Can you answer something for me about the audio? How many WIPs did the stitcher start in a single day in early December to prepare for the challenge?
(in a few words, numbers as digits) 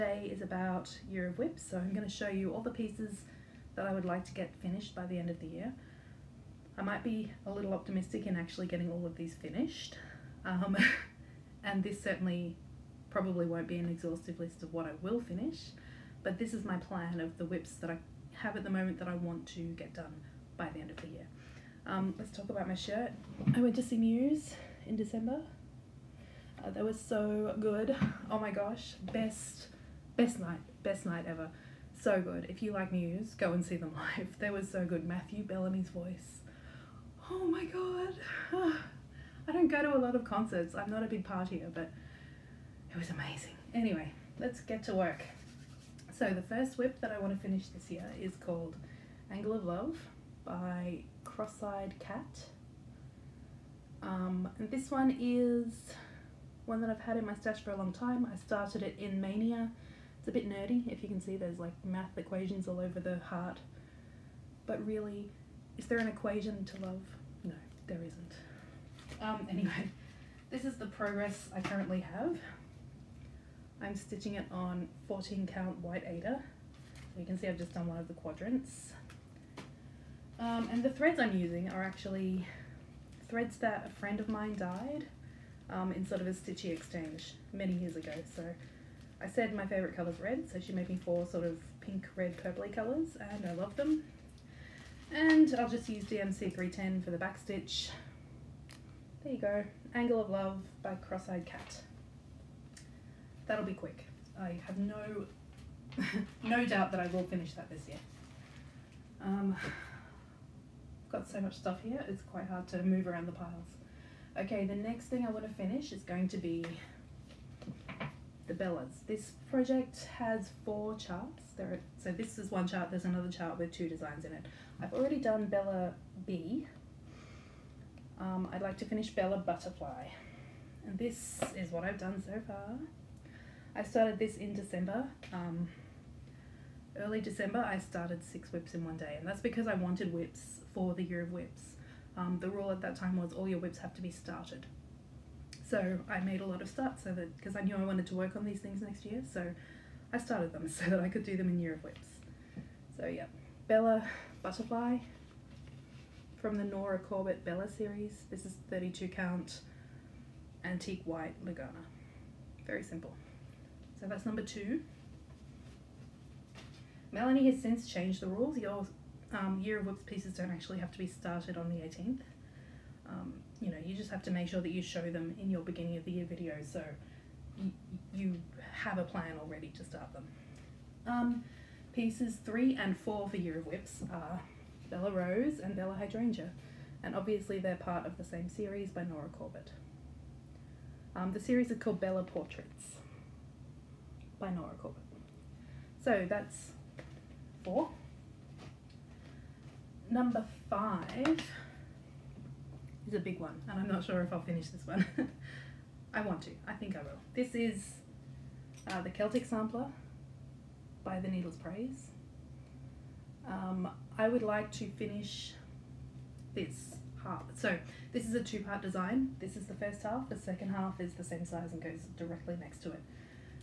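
6.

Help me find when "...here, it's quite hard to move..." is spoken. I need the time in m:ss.
1:51.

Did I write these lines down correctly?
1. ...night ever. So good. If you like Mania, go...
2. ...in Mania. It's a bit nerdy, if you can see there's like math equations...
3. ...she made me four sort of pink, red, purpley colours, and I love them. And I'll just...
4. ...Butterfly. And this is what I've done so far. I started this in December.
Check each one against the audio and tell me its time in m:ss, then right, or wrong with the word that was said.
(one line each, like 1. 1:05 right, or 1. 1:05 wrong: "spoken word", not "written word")
1. 0:31 wrong: "Muse", not "Mania"
2. 0:58 right
3. 1:30 right
4. 2:09 right.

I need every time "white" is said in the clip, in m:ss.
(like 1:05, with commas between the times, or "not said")
1:15, 2:41.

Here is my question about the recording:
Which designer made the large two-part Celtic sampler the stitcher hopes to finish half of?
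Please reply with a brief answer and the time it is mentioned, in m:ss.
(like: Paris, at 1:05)
The Needle's Prayse, at 3:31.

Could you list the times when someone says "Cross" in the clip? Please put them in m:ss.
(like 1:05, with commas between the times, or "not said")
0:51, 1:40.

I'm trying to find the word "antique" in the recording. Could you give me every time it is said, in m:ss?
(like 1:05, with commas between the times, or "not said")
2:40.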